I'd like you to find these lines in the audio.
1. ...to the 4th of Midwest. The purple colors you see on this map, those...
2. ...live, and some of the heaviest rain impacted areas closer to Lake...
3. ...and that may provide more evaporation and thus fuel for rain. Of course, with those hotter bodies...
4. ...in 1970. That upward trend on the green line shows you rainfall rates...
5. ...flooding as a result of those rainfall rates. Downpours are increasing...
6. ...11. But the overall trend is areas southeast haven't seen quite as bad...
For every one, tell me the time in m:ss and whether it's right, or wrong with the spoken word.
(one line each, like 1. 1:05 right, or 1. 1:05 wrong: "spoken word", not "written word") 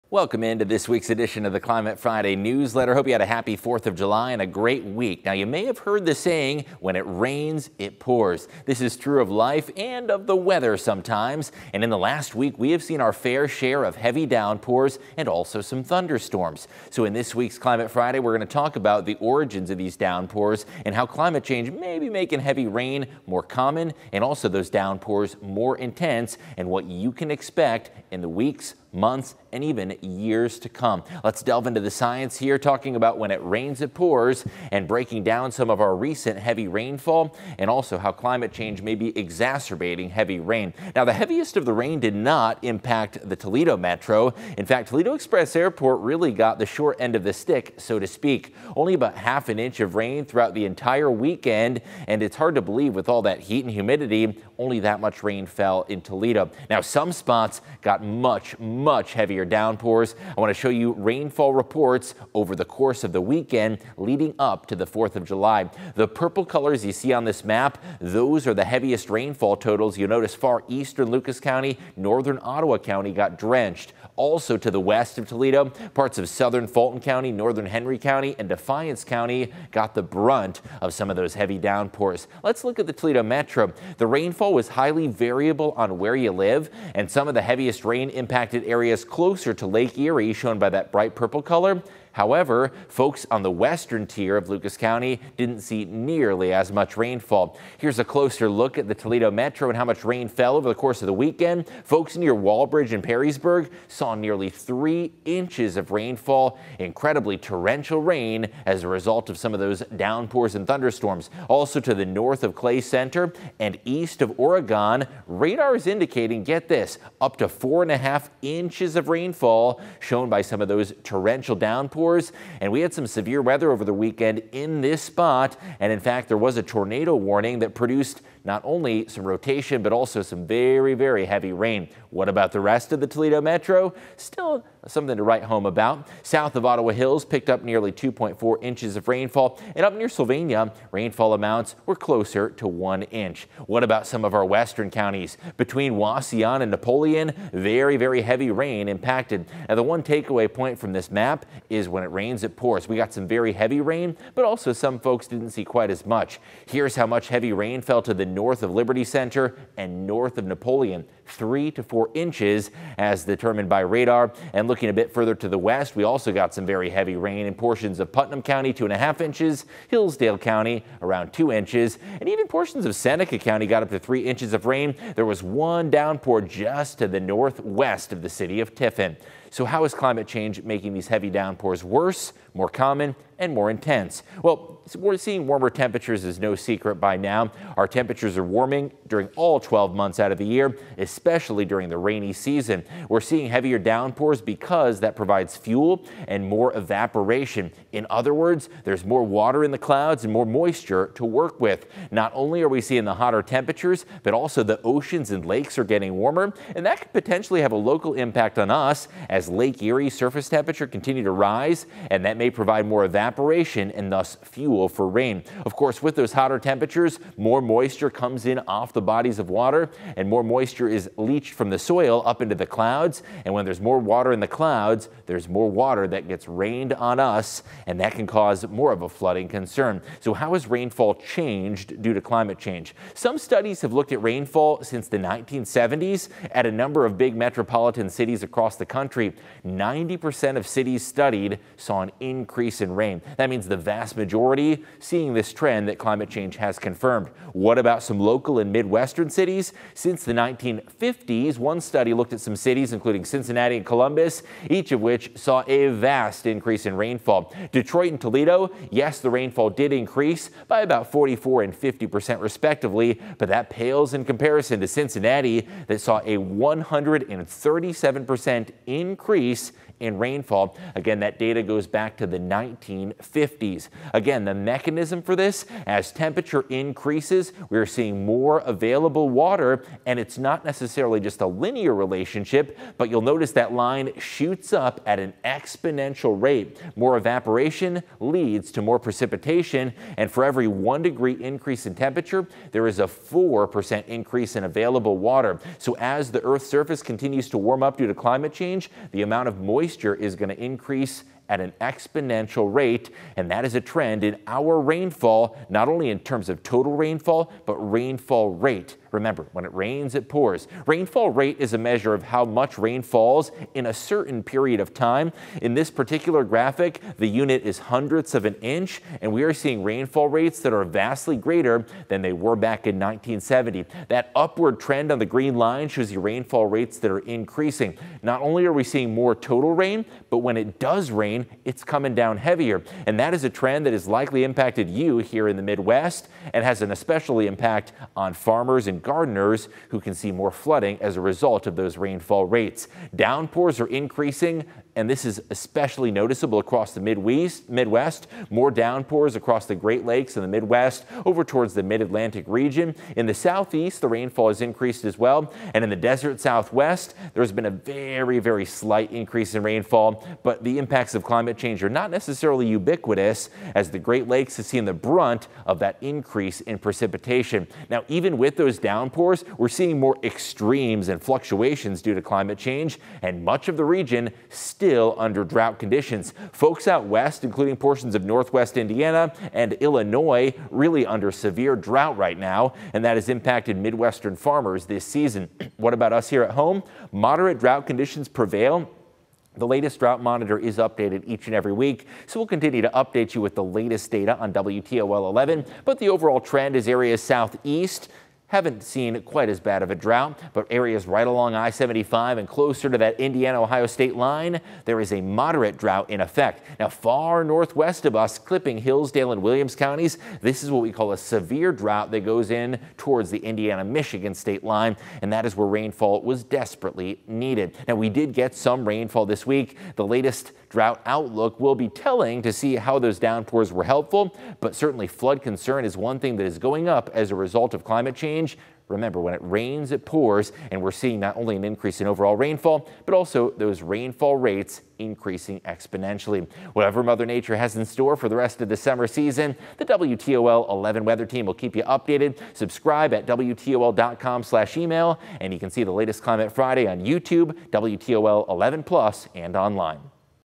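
1. 1:04 wrong: "July", not "Midwest"
2. 1:26 right
3. 3:32 wrong: "temperatures", not "bodies"
4. 5:22 right
5. 5:40 right
6. 6:35 right.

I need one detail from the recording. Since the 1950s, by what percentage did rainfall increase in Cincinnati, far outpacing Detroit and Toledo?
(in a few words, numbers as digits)
137%.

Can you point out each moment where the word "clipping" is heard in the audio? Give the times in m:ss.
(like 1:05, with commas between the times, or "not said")
6:48.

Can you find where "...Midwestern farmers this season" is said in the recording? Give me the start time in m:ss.
6:23.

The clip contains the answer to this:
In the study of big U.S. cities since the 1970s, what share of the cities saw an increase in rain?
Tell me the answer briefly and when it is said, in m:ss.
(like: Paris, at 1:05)
90%, at 3:59.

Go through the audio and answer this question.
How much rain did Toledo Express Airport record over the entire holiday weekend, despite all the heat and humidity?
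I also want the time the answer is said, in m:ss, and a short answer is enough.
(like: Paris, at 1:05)
half an inch, at 0:49.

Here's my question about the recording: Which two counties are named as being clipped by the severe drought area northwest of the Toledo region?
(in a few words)
Hillsdale and Williams.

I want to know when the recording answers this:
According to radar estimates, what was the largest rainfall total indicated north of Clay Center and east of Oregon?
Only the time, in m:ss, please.
1:57.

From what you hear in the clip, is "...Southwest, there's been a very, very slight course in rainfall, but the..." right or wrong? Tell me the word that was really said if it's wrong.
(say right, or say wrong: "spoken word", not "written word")
wrong: "increase", not "course".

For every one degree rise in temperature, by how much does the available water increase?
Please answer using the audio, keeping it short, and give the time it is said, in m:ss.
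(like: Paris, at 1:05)
4%, at 4:53.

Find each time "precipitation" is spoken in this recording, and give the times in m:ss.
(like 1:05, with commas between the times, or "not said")
4:48, 6:06.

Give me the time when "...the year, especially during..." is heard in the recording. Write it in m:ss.
3:10.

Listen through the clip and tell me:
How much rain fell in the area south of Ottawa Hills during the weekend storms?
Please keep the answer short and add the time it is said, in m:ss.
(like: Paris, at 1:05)
2.4 inches, at 2:17.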